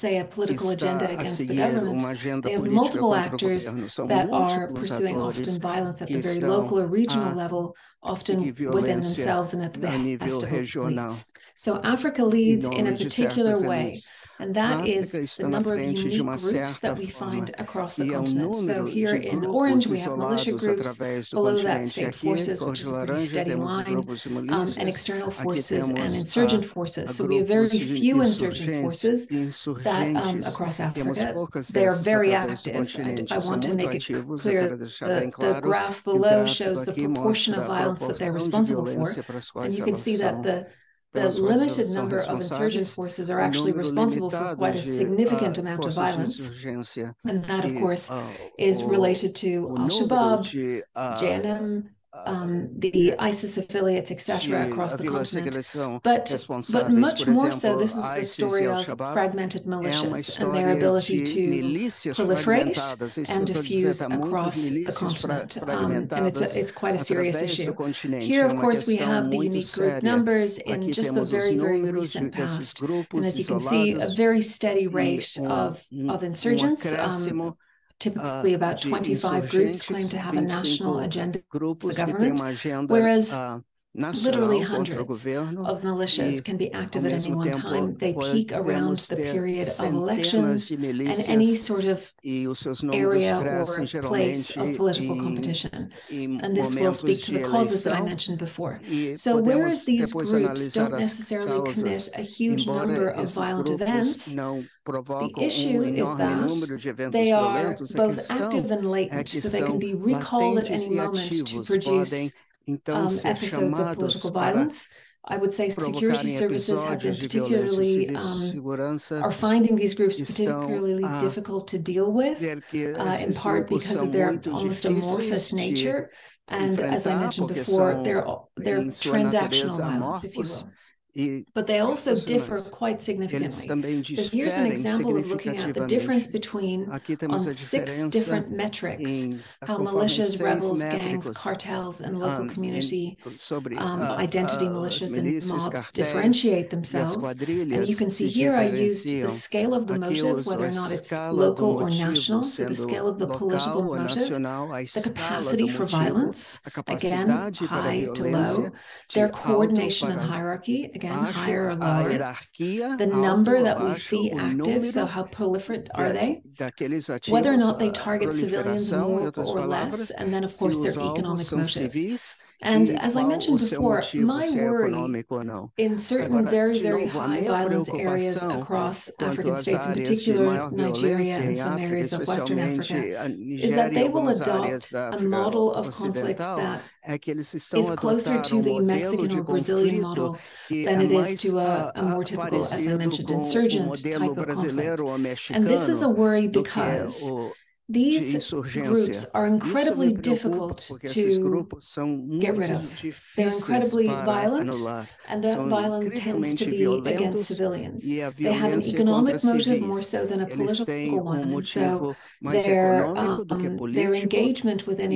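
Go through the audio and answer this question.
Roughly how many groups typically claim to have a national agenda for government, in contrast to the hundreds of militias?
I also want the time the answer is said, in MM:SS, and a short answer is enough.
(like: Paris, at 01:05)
25, at 01:18.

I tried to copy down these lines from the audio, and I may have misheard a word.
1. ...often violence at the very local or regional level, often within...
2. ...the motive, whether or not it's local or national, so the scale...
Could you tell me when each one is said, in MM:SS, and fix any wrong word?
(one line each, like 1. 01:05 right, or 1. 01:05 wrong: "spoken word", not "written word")
1. 00:05 right
2. 02:29 right.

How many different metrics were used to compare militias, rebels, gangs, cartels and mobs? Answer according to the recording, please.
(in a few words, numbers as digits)
6.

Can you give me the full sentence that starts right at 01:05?
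Um, and it's, a, it's quite a serious issue.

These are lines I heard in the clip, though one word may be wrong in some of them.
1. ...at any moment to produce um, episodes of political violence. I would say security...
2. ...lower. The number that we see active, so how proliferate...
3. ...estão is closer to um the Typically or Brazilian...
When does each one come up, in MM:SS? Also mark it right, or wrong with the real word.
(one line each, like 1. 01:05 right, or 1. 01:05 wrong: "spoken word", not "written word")
1. 01:50 right
2. 02:41 right
3. 03:07 wrong: "Mexican", not "Typically".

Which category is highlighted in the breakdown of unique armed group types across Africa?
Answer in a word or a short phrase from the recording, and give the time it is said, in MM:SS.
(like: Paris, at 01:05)
Militia groups, at 00:20.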